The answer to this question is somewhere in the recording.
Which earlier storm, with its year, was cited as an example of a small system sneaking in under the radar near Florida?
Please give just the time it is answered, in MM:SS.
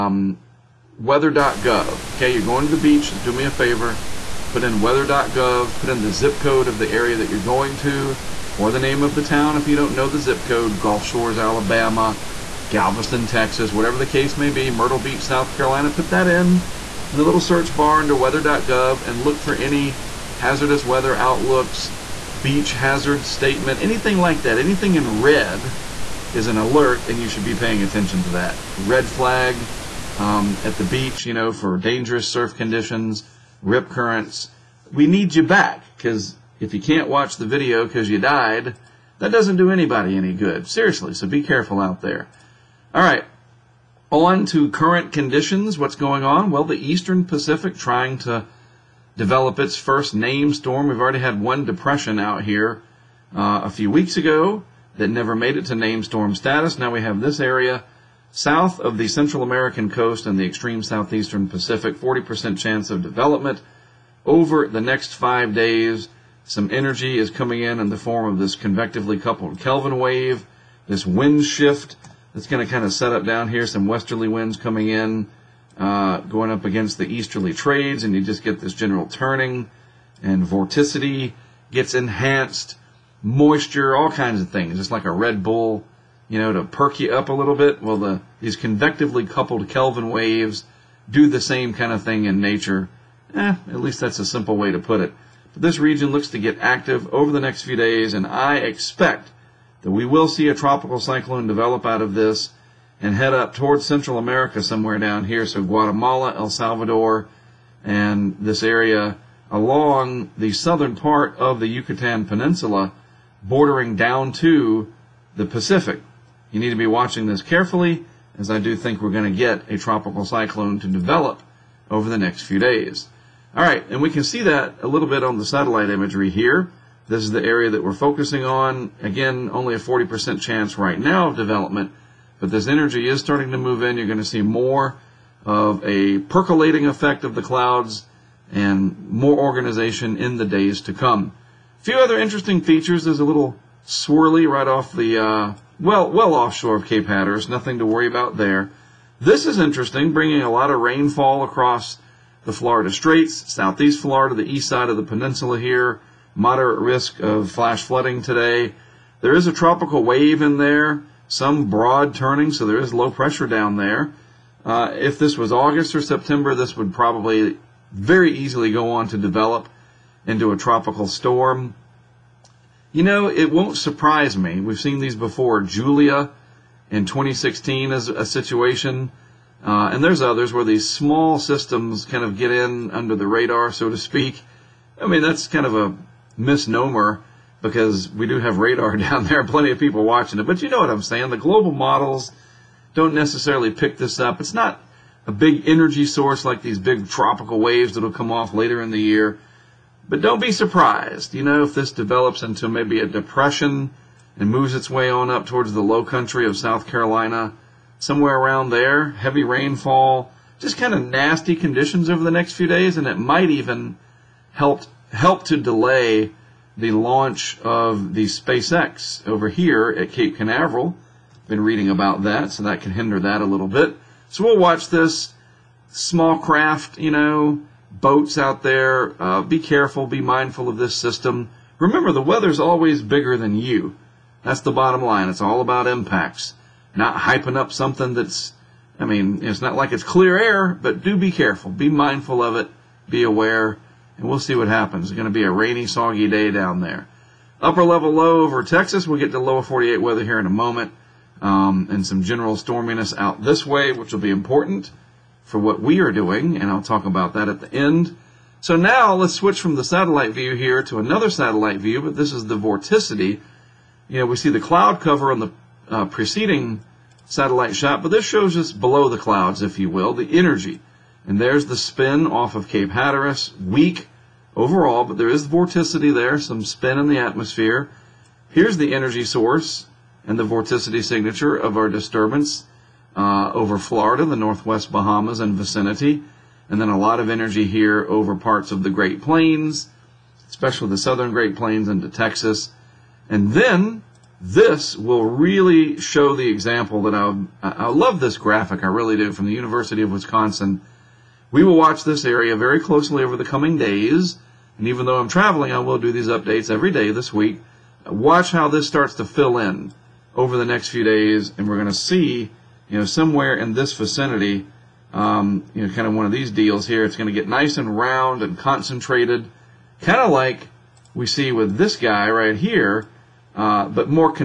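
02:55.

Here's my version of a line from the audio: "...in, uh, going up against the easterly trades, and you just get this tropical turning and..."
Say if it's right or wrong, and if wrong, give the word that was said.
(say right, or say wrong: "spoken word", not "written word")
wrong: "general", not "tropical".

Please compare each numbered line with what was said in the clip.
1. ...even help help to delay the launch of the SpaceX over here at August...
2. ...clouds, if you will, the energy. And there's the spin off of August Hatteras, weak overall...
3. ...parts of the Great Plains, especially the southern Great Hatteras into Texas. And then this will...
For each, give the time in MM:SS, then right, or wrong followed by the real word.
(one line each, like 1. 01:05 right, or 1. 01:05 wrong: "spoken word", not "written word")
1. 03:33 wrong: "Cape", not "August"
2. 04:29 wrong: "Cape", not "August"
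3. 04:48 wrong: "Plains", not "Hatteras".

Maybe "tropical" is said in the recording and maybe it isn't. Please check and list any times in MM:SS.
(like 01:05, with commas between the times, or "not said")
01:40, 01:59, 02:39, 02:50, 03:17.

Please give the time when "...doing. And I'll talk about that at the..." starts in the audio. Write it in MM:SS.
04:16.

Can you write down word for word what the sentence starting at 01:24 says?
It's like a Red Bull, you know, to perk you up a little bit.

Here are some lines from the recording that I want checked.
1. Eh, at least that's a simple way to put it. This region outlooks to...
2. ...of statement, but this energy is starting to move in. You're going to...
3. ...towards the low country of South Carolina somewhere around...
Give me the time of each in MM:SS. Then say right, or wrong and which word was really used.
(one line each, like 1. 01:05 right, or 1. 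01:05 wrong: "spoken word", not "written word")
1. 01:33 wrong: "looks", not "outlooks"
2. 02:11 wrong: "development", not "statement"
3. 03:25 right.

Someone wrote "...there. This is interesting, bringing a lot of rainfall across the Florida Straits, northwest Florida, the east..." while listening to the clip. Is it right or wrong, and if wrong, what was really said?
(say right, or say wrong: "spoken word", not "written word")
wrong: "southeast", not "northwest".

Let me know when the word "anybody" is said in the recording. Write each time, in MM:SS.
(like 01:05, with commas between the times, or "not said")
00:39.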